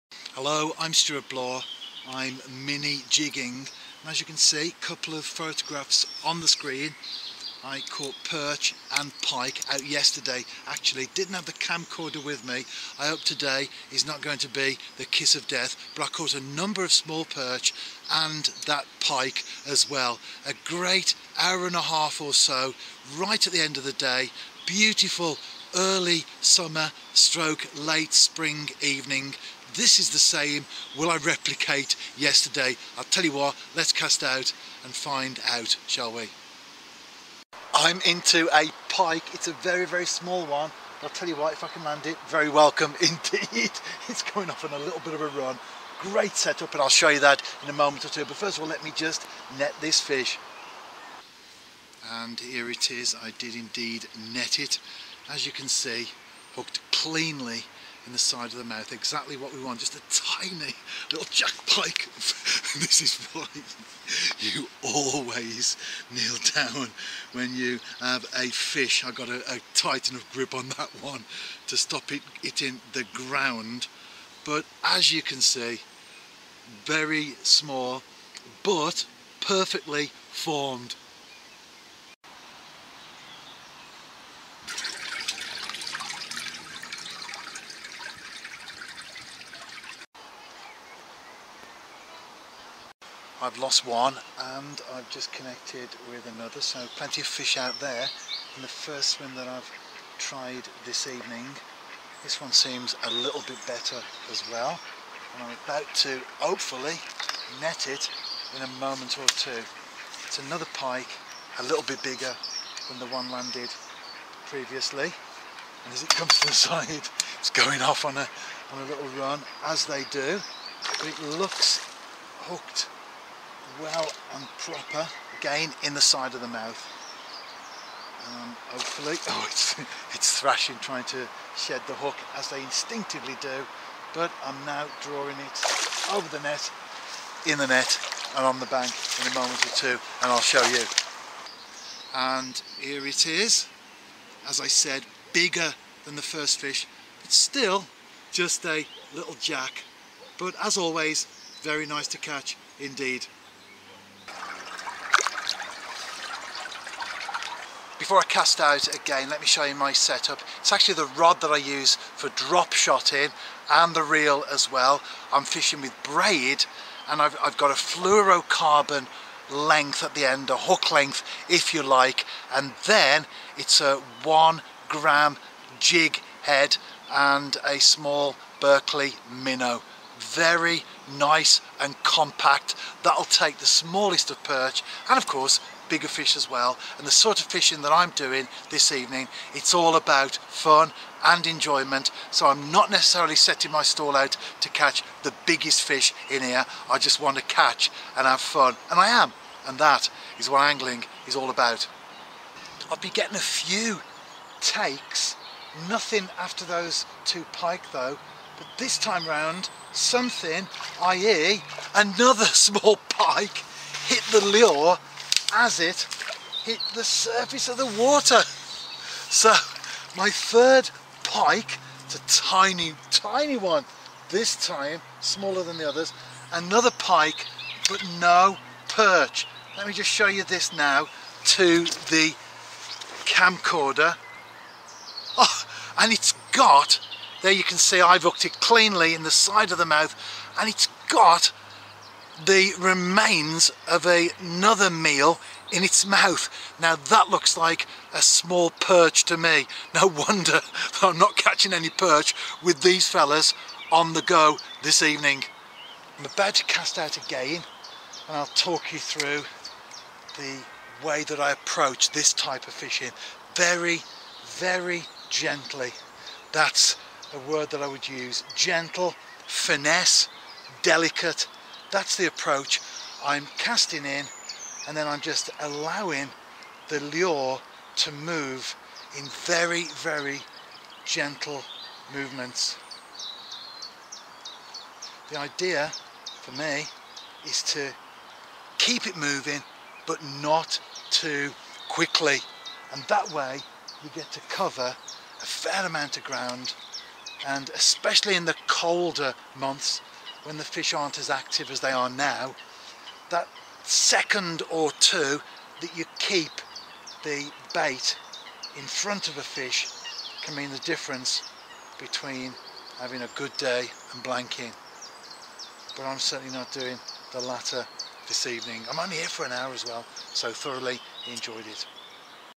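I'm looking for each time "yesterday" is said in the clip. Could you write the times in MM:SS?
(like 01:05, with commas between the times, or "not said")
00:09, 00:32.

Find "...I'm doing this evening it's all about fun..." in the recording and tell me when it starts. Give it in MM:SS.
03:07.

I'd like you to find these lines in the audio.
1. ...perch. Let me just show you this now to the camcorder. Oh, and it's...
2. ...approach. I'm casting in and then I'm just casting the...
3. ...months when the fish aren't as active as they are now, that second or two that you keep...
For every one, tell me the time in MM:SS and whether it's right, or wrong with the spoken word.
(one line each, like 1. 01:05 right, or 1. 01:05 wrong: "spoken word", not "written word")
1. 03:48 right
2. 04:32 wrong: "allowing", not "casting"
3. 04:59 right.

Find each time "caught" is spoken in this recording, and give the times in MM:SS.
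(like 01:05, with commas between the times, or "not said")
00:07, 00:16.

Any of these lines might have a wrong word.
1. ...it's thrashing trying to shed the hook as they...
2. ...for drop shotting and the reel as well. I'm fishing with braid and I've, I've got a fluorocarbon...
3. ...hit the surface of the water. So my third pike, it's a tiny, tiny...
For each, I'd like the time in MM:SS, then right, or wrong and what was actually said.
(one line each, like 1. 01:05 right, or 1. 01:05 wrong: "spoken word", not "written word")
1. 02:10 right
2. 02:42 right
3. 03:36 right.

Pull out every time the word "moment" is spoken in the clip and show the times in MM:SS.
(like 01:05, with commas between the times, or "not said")
00:47, 01:48, 02:19.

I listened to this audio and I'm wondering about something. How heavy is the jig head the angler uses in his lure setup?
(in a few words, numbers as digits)
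1 gram.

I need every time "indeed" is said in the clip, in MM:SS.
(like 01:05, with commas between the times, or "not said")
00:43, 00:53, 02:32.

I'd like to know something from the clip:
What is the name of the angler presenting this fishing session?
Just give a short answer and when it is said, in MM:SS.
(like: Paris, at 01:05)
Stewart Bloor, at 00:00.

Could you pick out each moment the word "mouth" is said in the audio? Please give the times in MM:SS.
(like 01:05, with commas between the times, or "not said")
00:58, 02:06, 03:59, 04:06.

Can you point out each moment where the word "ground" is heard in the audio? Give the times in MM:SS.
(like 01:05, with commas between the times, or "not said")
01:13, 04:56.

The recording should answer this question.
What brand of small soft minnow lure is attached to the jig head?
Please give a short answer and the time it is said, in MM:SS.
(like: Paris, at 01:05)
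Berkley, at 02:58.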